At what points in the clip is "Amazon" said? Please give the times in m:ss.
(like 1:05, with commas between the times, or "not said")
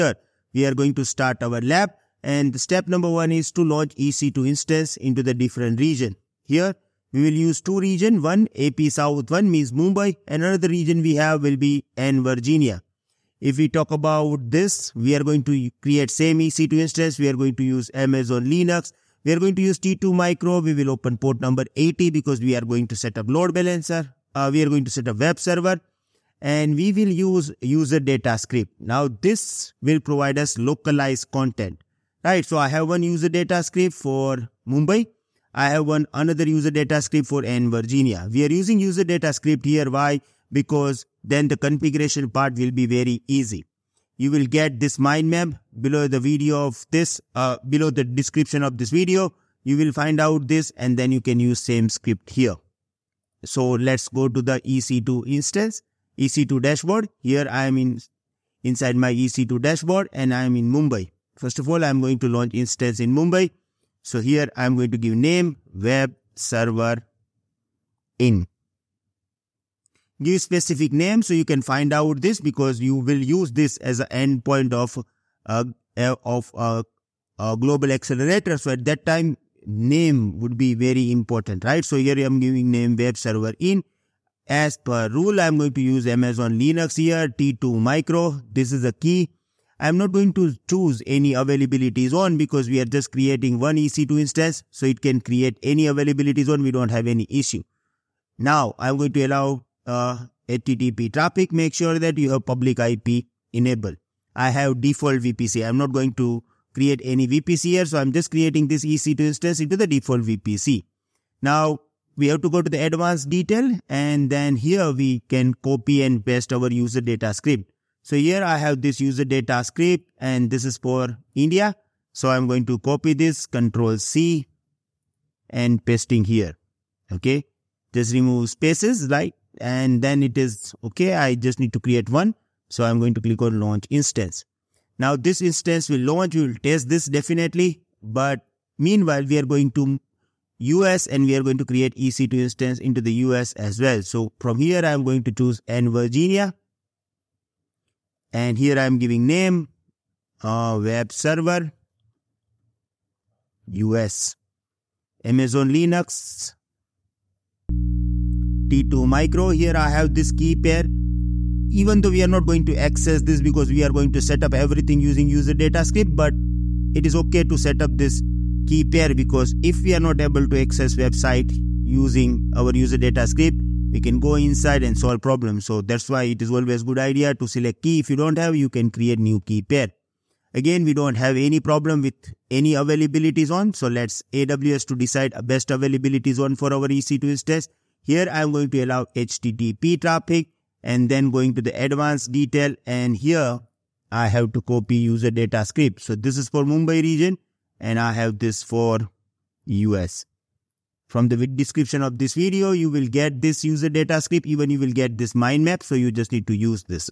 0:17, 1:26, 2:35.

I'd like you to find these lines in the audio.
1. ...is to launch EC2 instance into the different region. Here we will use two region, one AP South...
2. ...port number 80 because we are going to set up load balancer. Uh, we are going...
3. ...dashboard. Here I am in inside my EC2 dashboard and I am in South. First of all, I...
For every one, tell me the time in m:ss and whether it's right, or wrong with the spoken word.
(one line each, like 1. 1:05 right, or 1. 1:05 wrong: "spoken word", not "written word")
1. 0:03 right
2. 0:21 right
3. 0:56 wrong: "Mumbai", not "South".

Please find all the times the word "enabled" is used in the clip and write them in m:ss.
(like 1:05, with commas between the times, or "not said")
1:43.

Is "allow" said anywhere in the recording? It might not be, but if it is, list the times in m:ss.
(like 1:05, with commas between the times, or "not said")
1:39, 3:08.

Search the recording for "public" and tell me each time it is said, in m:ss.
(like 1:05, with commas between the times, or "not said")
1:42.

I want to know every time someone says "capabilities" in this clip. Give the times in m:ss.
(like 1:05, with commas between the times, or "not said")
not said.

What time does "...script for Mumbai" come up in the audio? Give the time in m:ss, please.
0:33.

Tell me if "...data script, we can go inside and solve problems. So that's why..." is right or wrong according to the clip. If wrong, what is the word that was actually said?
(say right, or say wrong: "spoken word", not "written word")
right.